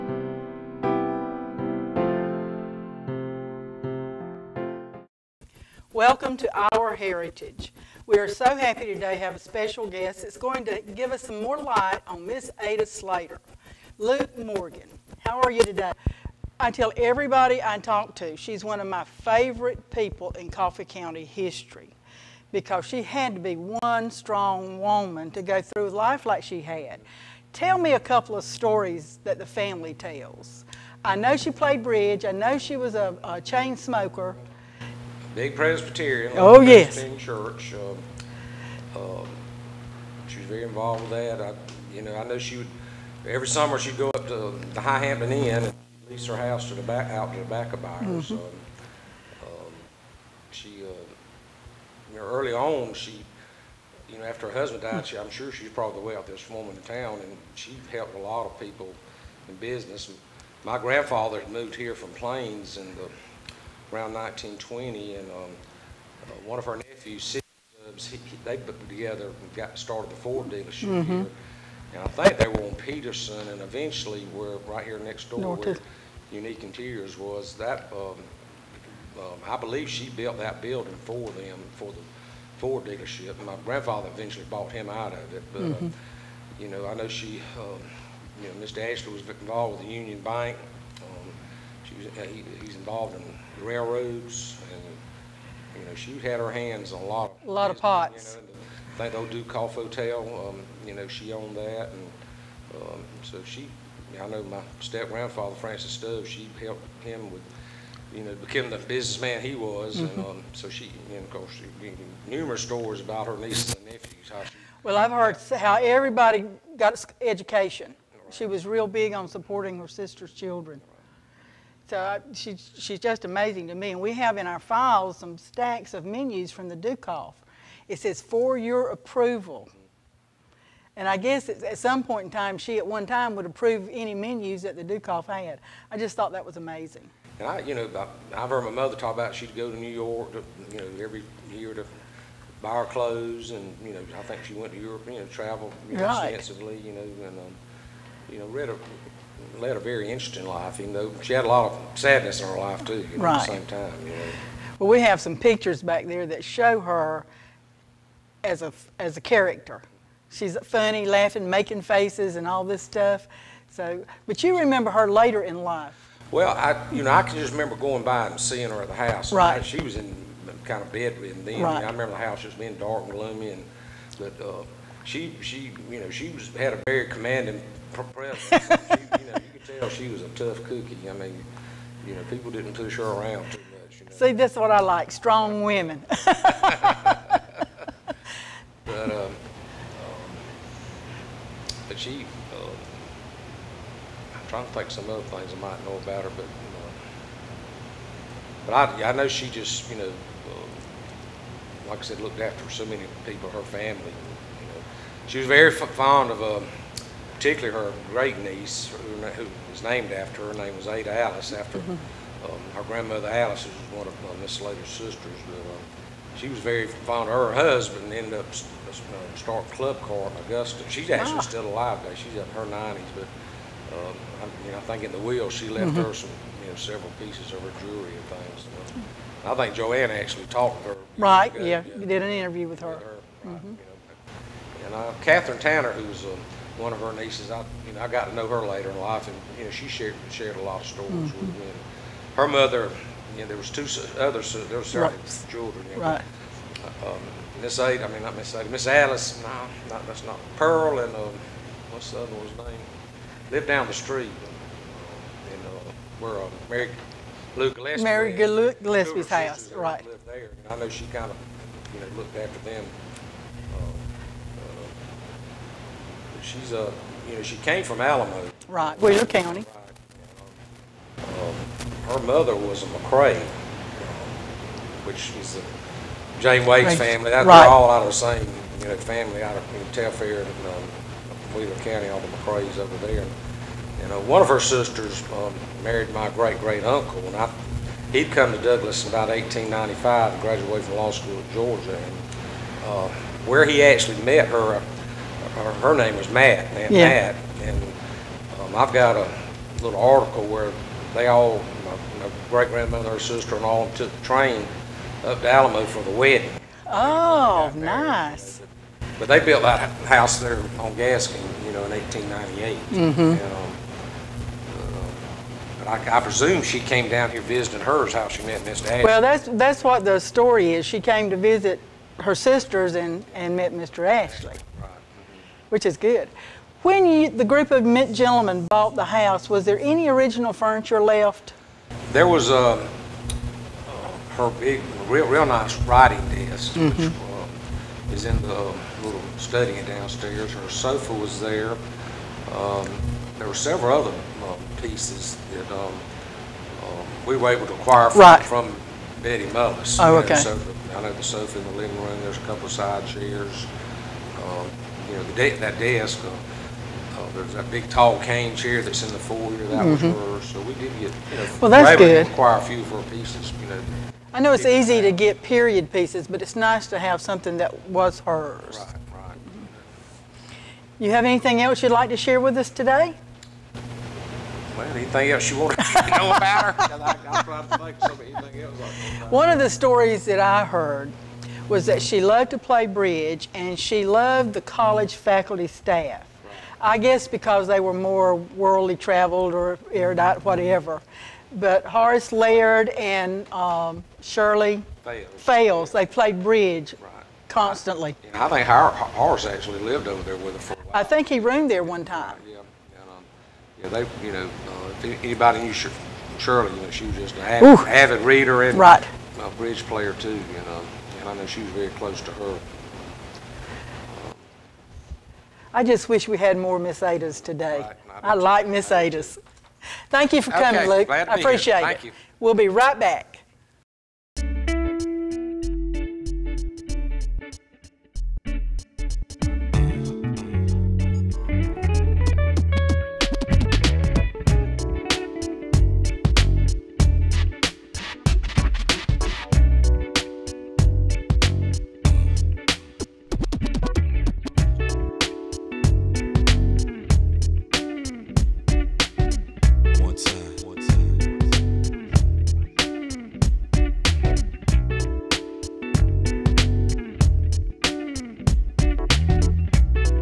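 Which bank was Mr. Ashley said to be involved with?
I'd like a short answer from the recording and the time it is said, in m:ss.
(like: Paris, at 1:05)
Union Bank, at 1:30.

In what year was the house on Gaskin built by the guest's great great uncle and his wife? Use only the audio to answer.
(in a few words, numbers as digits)
1898.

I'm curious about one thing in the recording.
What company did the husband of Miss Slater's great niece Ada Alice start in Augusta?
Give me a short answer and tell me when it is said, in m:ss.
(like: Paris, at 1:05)
Club Car, at 3:39.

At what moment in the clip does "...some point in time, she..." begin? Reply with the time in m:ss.
2:11.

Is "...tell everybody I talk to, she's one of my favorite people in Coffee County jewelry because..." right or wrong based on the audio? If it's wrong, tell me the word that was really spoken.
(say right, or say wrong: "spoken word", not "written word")
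wrong: "history", not "jewelry".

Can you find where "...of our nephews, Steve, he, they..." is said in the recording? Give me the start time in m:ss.
1:06.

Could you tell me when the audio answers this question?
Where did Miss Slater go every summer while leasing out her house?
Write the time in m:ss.
0:44.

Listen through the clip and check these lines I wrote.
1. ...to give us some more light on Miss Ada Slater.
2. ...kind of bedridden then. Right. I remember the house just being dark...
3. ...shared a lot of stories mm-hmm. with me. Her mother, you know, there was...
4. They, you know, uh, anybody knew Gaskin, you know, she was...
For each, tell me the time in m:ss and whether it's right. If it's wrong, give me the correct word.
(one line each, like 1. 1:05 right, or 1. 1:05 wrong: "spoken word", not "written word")
1. 0:10 right
2. 2:50 right
3. 4:00 right
4. 6:44 wrong: "Shirley", not "Gaskin".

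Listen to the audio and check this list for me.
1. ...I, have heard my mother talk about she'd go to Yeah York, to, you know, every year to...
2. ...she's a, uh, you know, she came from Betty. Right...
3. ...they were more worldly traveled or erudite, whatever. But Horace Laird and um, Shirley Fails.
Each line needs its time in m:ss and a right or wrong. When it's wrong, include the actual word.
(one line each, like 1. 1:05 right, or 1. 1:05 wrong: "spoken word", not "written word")
1. 2:18 wrong: "New", not "Yeah"
2. 4:26 wrong: "Alamo", not "Betty"
3. 6:27 right.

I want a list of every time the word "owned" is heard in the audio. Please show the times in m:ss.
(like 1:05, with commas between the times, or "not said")
1:41.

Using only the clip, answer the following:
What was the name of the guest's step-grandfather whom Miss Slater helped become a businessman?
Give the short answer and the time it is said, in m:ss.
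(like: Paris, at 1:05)
Francis Stubbs, at 1:45.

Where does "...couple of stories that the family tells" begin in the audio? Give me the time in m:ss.
0:27.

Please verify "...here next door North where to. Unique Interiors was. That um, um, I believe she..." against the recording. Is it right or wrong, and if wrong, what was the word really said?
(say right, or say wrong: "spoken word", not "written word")
right.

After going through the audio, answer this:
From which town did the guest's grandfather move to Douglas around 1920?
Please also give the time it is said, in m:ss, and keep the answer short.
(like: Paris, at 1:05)
Plains, at 1:02.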